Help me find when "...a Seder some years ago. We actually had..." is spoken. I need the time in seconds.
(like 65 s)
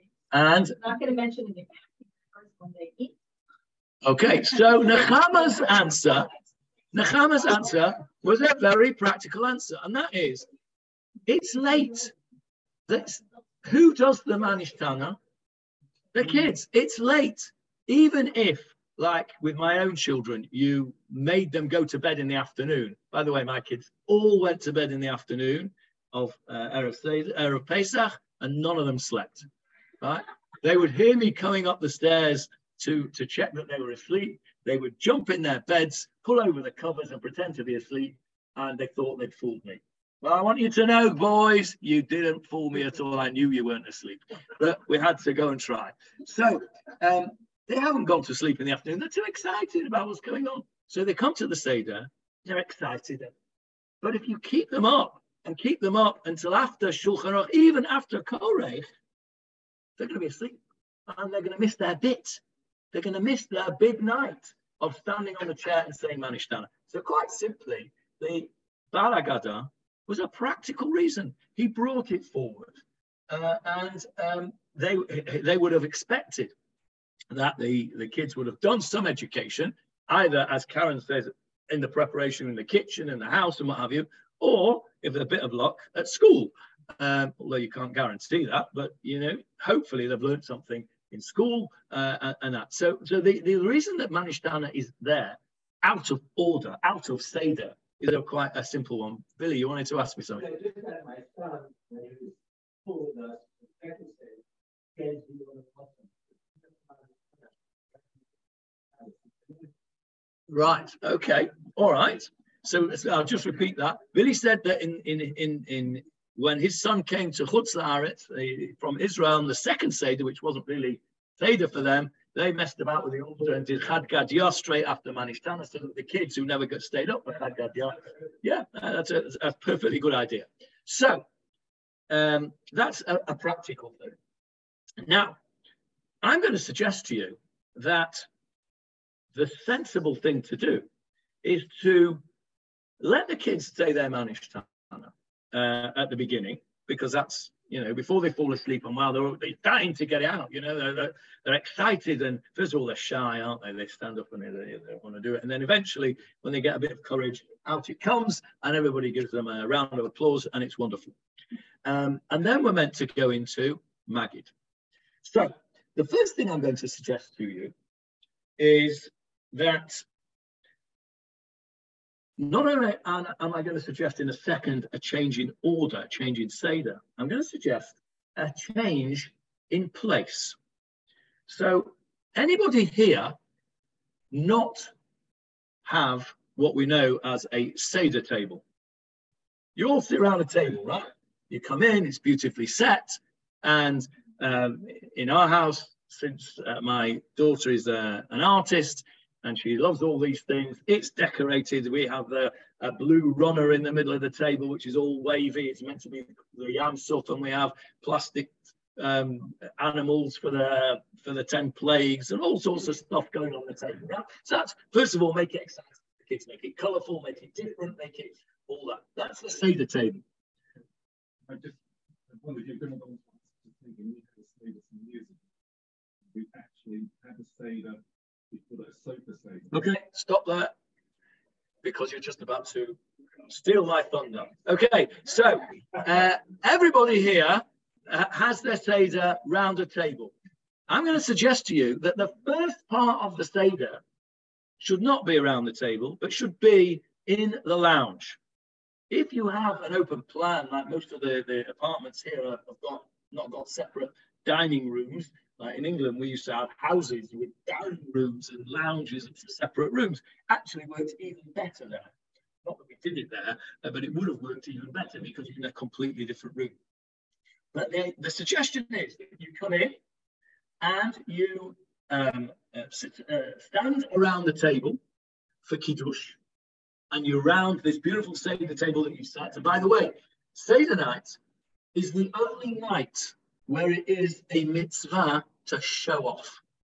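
224 s.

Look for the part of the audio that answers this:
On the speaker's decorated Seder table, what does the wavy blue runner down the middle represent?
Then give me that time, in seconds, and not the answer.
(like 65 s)
206 s.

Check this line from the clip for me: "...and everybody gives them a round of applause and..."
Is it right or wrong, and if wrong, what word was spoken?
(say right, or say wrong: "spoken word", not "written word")
right.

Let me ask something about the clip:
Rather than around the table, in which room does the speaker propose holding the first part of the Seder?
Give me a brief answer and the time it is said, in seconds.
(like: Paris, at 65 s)
The lounge, at 247 s.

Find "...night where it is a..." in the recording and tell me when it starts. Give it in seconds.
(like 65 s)
282 s.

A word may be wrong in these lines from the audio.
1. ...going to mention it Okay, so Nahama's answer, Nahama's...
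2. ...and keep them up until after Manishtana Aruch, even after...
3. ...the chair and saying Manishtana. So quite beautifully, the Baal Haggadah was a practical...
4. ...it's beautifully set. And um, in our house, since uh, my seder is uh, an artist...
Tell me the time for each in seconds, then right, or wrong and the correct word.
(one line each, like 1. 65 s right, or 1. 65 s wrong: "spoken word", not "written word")
1. 0 s right
2. 55 s wrong: "Shulchan", not "Manishtana"
3. 65 s wrong: "simply", not "beautifully"
4. 192 s wrong: "daughter", not "seder".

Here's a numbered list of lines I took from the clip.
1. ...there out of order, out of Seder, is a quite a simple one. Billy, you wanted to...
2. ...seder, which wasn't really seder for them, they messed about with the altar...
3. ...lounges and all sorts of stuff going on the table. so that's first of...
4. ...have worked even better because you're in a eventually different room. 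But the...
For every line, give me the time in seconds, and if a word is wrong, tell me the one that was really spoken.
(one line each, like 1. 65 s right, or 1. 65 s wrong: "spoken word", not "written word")
1. 94 s right
2. 119 s right
3. 211 s wrong: "plagues", not "lounges"
4. 264 s wrong: "completely", not "eventually".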